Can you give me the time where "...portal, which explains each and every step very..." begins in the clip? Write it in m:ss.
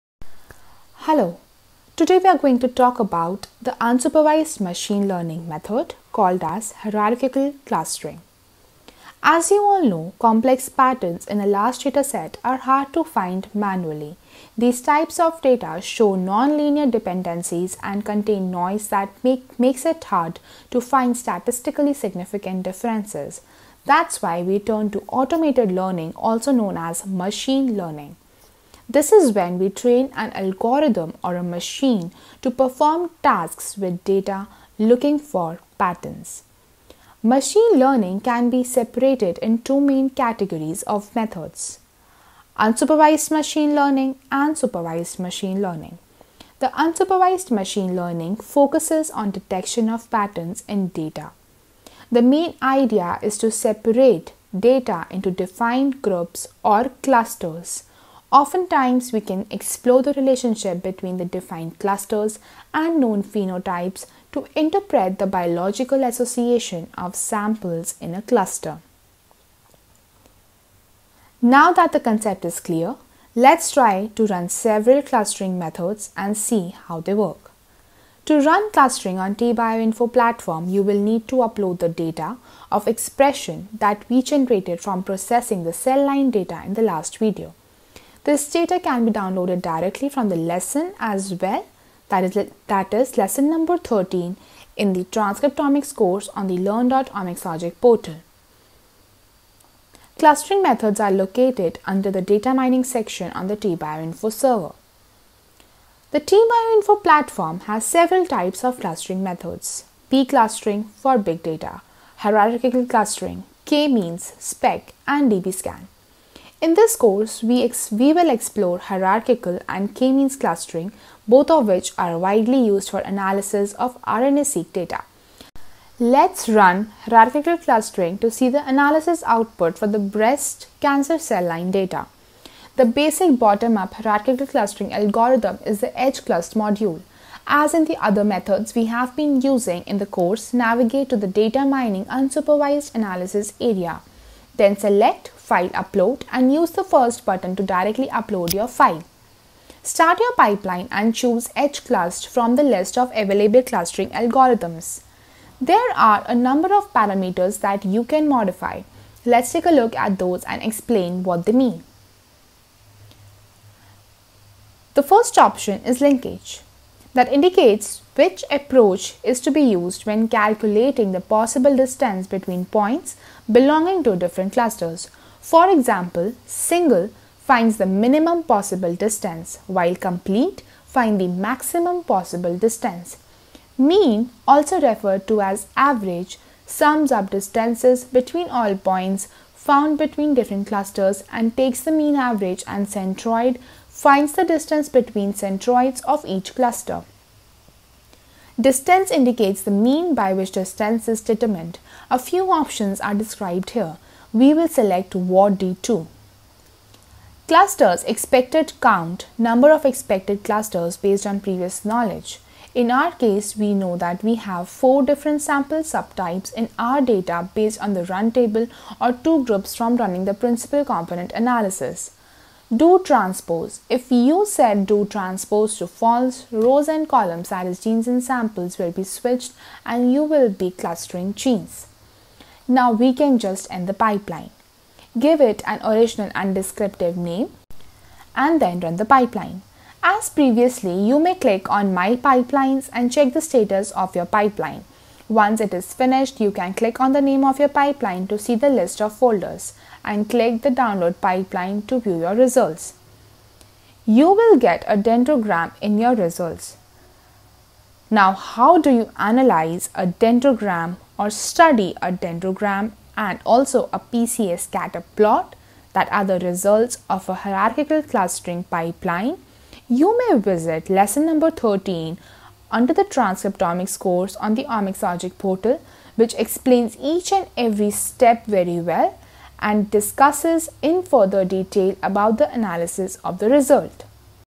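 4:35.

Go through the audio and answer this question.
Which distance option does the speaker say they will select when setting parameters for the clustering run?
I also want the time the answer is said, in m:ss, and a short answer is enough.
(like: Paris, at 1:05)
Ward D2, at 3:25.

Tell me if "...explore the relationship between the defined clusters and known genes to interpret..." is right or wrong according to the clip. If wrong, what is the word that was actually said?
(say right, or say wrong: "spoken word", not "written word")
wrong: "phenotypes", not "genes".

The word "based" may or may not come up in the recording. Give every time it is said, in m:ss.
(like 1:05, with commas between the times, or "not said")
3:30, 3:37.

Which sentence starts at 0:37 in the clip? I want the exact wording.
Machine learning can be separated in two main categories of methods unsupervised machine learning and supervised machine learning.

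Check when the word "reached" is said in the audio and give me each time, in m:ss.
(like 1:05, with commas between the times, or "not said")
not said.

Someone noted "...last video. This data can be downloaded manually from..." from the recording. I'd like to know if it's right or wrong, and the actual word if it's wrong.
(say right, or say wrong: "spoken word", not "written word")
wrong: "directly", not "manually".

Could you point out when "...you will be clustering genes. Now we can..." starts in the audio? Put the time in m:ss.
3:50.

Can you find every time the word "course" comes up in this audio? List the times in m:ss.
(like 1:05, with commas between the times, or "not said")
1:35, 1:56, 2:20, 4:33.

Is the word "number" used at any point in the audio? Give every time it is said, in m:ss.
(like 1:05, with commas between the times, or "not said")
1:33, 2:36, 3:29, 4:31.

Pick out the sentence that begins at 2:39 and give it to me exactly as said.
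Let's take a look at those and explain what they mean.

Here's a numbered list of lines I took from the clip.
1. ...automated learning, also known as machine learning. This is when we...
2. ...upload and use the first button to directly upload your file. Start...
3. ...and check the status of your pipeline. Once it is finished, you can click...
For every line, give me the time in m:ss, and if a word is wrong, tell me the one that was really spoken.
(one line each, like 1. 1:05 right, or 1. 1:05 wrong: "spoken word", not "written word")
1. 0:25 right
2. 2:25 right
3. 4:02 right.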